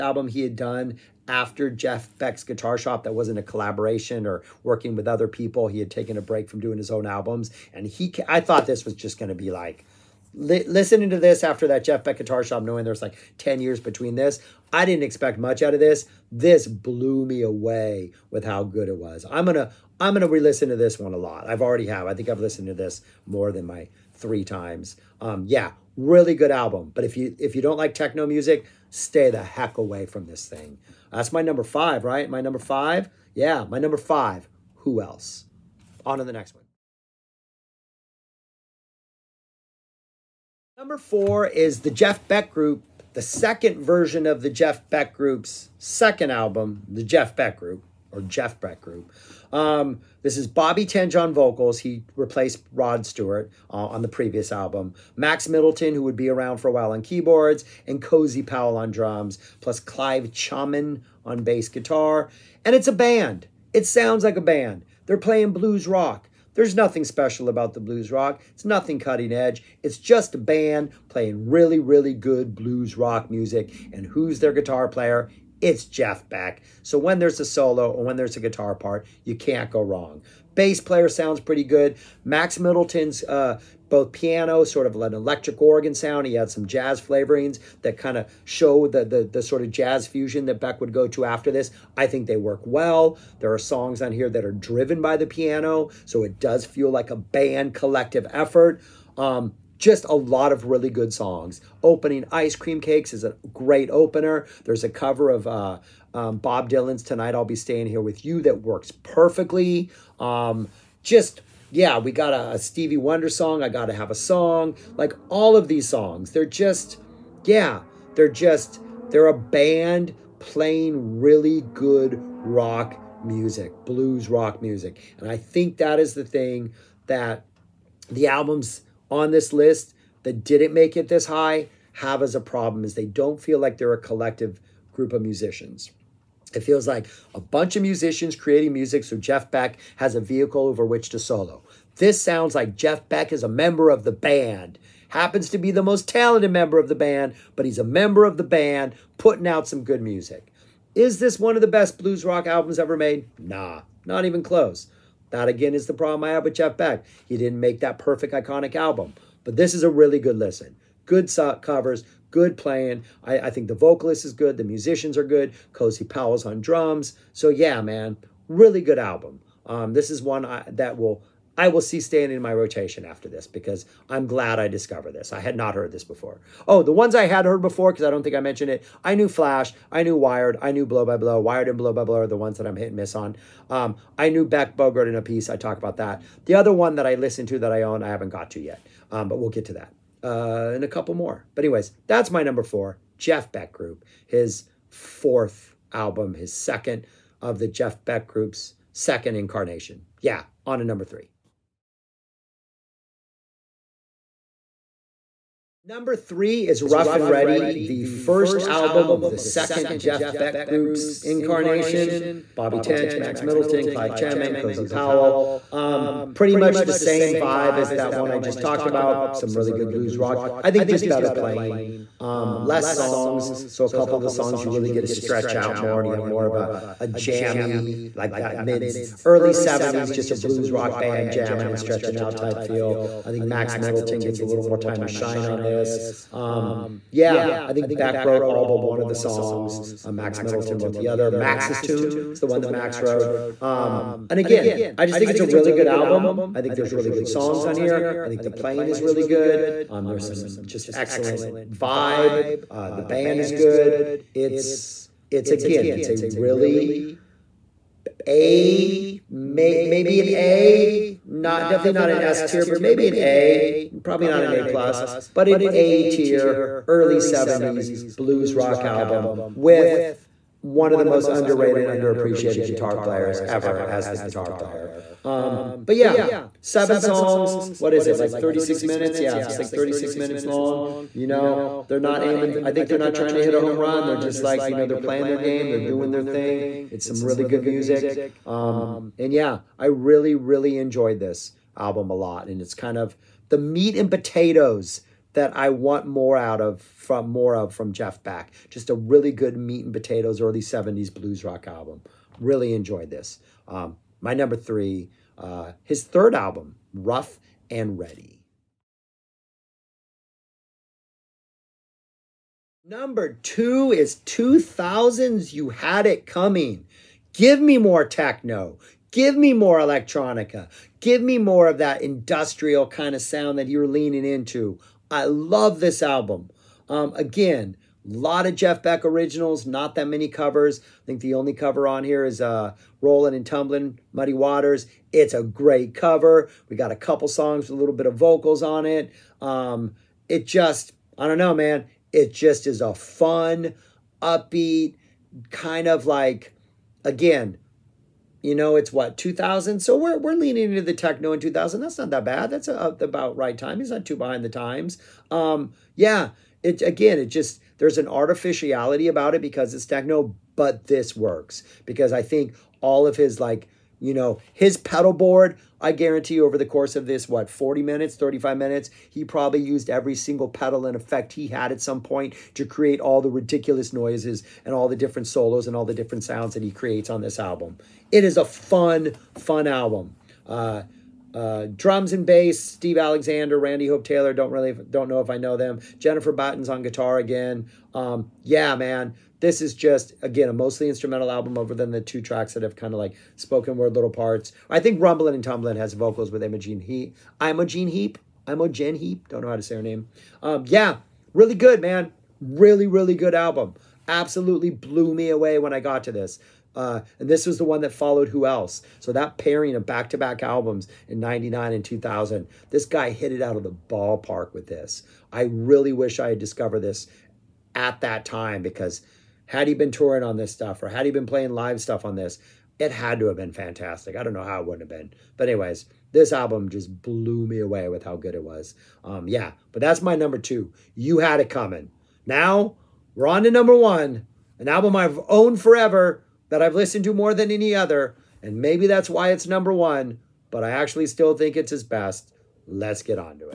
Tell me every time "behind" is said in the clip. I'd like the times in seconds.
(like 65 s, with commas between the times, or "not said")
354 s.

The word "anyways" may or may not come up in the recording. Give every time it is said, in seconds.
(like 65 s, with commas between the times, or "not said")
191 s, 425 s.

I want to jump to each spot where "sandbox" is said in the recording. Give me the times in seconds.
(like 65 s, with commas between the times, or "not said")
not said.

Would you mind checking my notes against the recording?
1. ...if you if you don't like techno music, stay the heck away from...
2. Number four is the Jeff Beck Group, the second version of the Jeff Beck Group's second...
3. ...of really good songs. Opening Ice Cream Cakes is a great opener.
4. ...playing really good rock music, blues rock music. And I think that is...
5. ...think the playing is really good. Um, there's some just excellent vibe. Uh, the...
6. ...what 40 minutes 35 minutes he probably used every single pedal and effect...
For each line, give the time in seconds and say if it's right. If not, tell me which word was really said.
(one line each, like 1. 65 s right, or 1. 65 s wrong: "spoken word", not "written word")
1. 27 s right
2. 40 s right
3. 100 s right
4. 120 s right
5. 248 s right
6. 367 s right.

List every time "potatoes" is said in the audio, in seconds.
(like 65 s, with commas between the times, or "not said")
294 s, 299 s.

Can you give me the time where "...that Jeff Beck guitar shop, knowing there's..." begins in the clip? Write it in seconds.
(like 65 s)
11 s.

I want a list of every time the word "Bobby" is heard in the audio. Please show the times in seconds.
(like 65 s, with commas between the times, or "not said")
50 s, 212 s.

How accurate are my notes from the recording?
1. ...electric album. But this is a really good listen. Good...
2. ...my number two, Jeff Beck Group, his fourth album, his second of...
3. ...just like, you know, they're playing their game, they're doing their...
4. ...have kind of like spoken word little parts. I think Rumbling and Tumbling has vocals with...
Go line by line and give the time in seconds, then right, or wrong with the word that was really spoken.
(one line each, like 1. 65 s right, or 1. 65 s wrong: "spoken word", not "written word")
1. 158 s wrong: "iconic", not "electric"
2. 192 s wrong: "four", not "two"
3. 284 s right
4. 392 s right.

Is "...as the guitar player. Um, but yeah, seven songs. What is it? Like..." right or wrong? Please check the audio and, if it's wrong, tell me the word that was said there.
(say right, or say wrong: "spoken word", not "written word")
right.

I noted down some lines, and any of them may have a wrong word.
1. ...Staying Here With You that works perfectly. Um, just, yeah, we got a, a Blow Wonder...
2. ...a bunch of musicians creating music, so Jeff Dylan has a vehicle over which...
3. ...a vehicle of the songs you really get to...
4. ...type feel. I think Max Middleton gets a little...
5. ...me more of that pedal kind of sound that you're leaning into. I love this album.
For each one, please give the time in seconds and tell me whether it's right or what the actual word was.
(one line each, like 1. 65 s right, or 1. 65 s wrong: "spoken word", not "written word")
1. 107 s wrong: "Stevie", not "Blow"
2. 137 s wrong: "Beck", not "Dylan"
3. 223 s wrong: "couple", not "vehicle"
4. 232 s right
5. 321 s wrong: "industrial", not "pedal".